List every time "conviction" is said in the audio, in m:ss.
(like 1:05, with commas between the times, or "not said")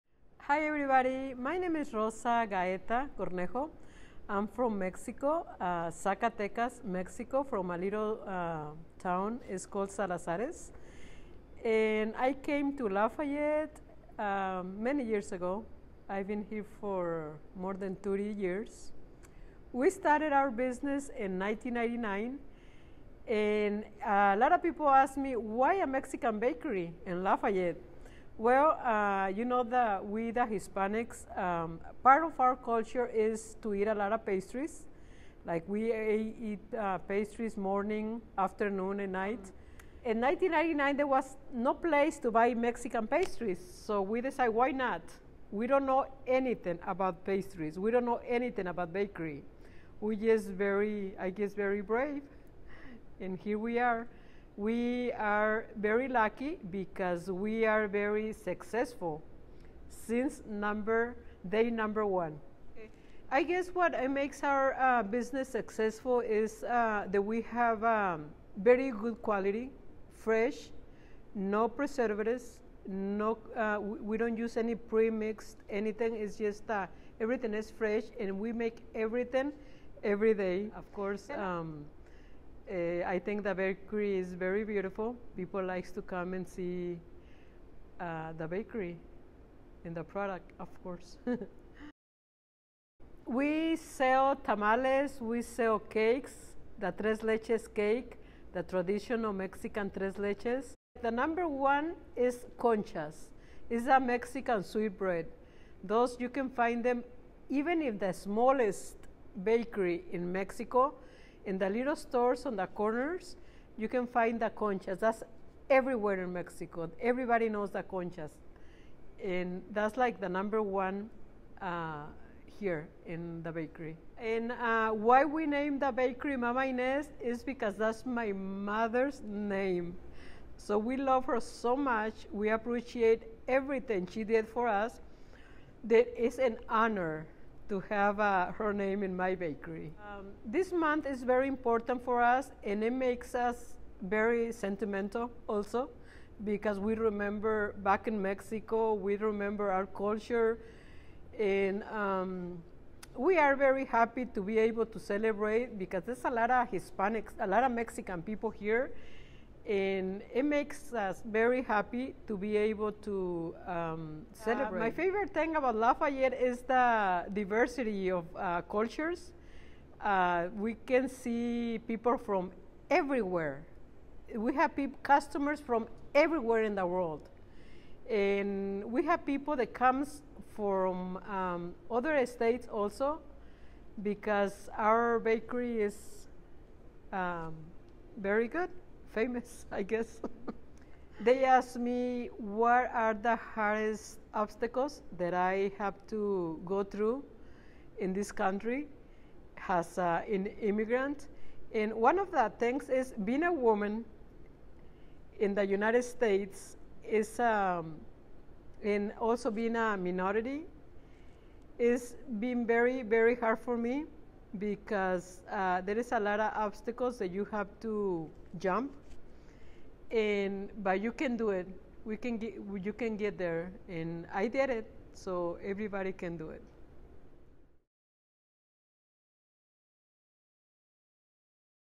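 not said.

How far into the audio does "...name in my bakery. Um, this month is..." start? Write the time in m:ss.
2:18.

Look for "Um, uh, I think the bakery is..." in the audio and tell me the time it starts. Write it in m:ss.
1:21.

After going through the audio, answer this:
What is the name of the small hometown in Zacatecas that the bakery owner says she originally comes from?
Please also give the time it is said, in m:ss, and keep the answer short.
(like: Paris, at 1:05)
Salazares, at 0:09.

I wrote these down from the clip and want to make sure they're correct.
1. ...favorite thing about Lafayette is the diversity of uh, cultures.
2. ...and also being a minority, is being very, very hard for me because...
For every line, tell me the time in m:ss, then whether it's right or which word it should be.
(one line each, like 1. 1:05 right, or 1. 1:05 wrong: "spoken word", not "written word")
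1. 2:44 right
2. 3:28 right.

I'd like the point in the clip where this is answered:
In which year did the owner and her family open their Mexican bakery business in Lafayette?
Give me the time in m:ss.
0:19.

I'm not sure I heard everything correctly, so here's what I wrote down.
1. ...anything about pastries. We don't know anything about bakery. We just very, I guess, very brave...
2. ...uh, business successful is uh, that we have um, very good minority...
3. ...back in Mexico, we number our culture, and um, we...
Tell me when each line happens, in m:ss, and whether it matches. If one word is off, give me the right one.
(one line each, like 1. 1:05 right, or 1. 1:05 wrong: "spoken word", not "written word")
1. 0:46 right
2. 1:04 wrong: "quality", not "minority"
3. 2:27 wrong: "remember", not "number".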